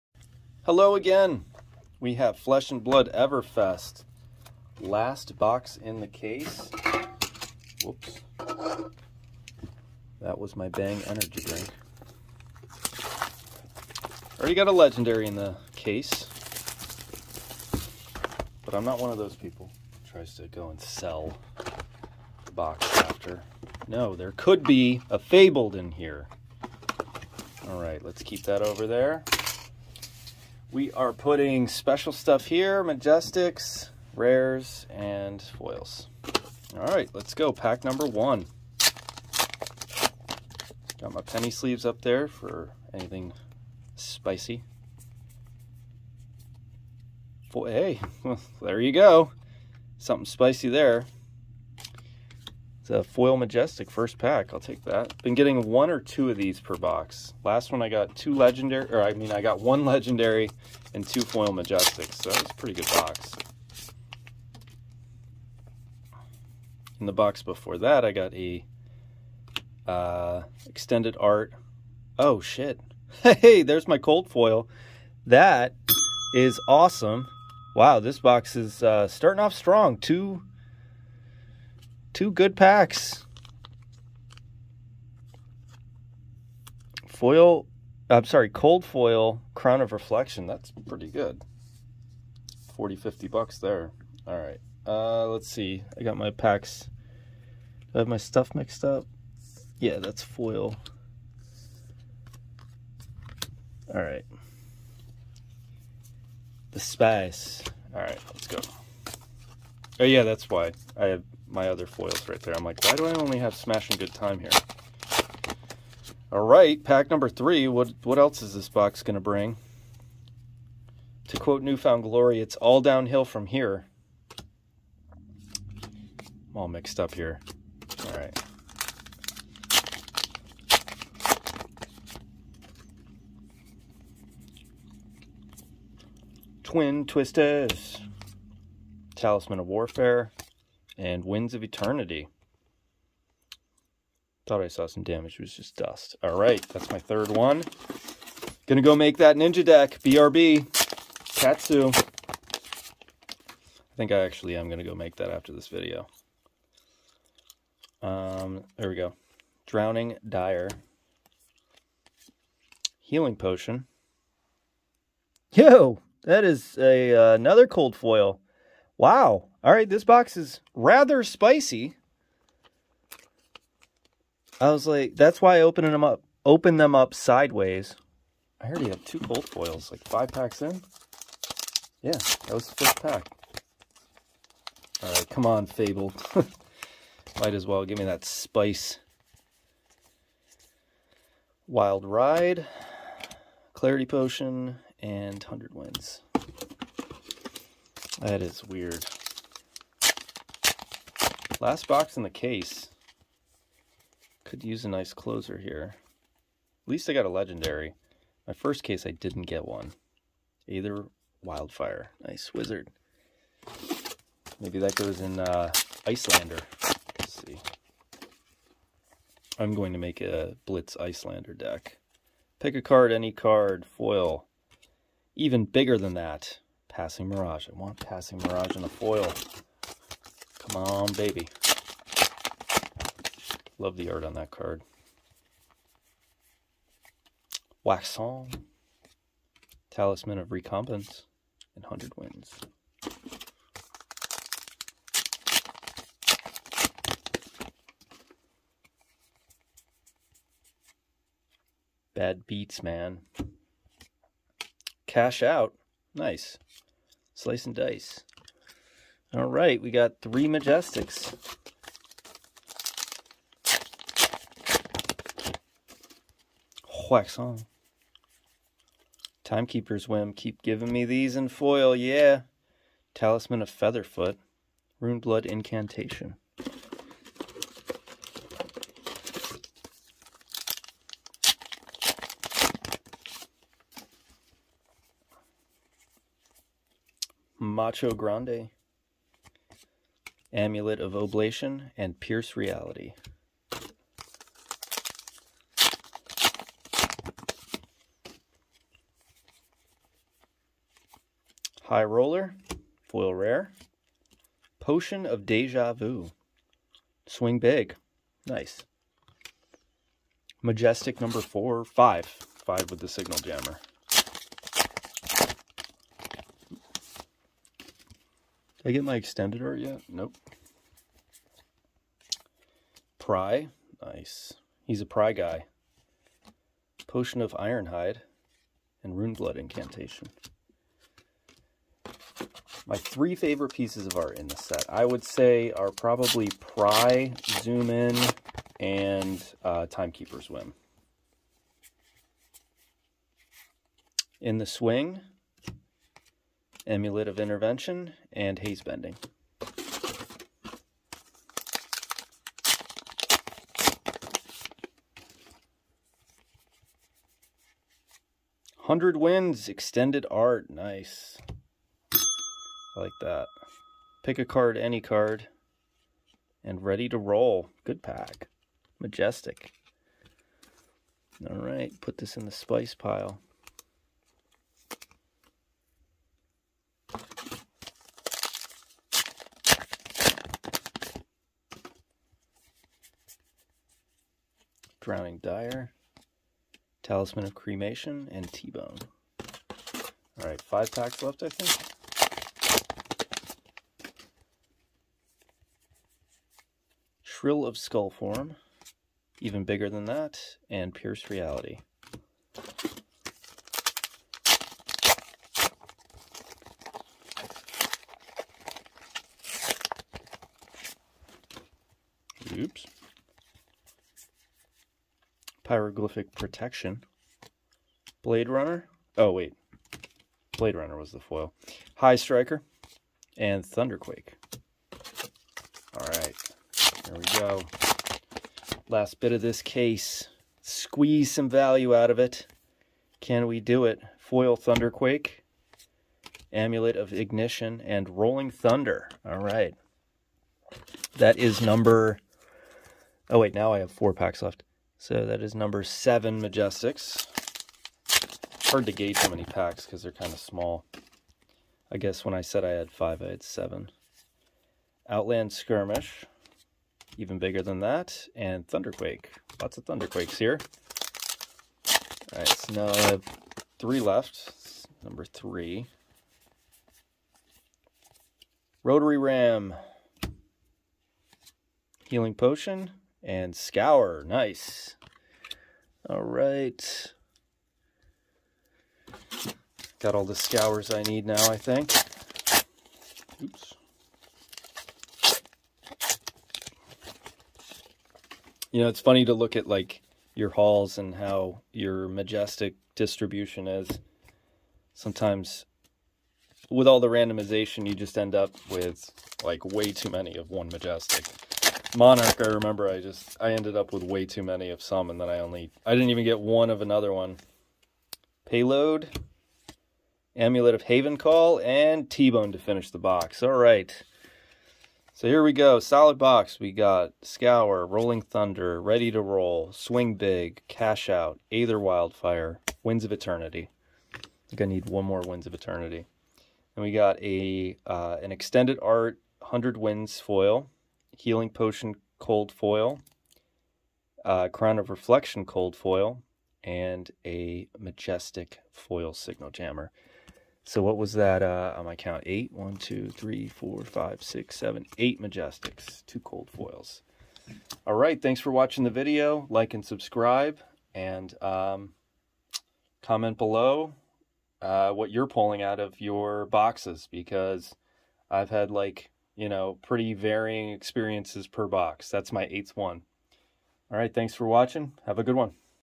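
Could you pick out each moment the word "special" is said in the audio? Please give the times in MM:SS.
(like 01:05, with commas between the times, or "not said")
00:31.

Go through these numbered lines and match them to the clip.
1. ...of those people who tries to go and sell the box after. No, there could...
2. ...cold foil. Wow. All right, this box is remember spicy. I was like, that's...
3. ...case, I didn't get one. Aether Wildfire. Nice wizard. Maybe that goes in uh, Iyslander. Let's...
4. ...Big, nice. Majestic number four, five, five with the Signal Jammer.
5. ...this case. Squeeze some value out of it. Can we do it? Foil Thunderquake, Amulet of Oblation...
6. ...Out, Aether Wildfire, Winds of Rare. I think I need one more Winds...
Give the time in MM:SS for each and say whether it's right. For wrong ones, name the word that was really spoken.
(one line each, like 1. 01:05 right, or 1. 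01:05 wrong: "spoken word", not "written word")
1. 00:19 right
2. 02:47 wrong: "rather", not "remember"
3. 03:28 right
4. 05:07 right
5. 07:09 wrong: "Ignition", not "Oblation"
6. 08:41 wrong: "Eternity", not "Rare".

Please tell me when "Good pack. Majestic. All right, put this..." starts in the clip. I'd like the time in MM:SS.
06:07.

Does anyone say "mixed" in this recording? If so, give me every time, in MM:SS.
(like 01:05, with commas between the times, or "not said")
01:38, 02:06.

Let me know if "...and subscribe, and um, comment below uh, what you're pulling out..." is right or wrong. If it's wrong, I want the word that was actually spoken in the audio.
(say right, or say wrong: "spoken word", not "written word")
right.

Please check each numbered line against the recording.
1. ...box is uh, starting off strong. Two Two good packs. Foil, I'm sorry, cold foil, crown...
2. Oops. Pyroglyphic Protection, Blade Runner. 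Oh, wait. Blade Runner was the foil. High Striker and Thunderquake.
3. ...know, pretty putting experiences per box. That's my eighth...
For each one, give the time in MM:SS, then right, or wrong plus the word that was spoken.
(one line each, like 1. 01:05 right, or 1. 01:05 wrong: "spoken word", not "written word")
1. 01:18 right
2. 06:52 right
3. 09:19 wrong: "varying", not "putting".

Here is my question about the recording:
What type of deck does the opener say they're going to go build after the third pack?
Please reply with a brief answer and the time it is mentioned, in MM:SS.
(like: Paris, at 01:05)
ninja deck, at 02:29.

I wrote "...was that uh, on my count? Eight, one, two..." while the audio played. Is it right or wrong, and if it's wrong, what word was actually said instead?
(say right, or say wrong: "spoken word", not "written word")
right.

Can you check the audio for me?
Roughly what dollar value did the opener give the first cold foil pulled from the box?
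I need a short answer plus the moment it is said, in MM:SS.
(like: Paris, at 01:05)
40 to 50 dollars, at 01:32.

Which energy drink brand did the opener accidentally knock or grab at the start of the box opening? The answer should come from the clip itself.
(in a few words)
Bang.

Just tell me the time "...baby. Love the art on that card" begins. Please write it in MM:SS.
03:51.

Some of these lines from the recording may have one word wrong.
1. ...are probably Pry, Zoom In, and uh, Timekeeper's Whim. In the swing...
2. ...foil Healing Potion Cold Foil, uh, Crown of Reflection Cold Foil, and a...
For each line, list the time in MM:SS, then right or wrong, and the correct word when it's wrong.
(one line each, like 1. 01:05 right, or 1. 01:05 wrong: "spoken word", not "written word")
1. 05:35 right
2. 08:50 right.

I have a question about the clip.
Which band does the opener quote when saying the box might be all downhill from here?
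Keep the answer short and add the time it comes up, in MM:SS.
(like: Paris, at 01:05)
New Found Glory, at 02:01.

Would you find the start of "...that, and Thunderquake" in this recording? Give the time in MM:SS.
07:37.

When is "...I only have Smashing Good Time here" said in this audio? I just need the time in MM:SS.
01:53.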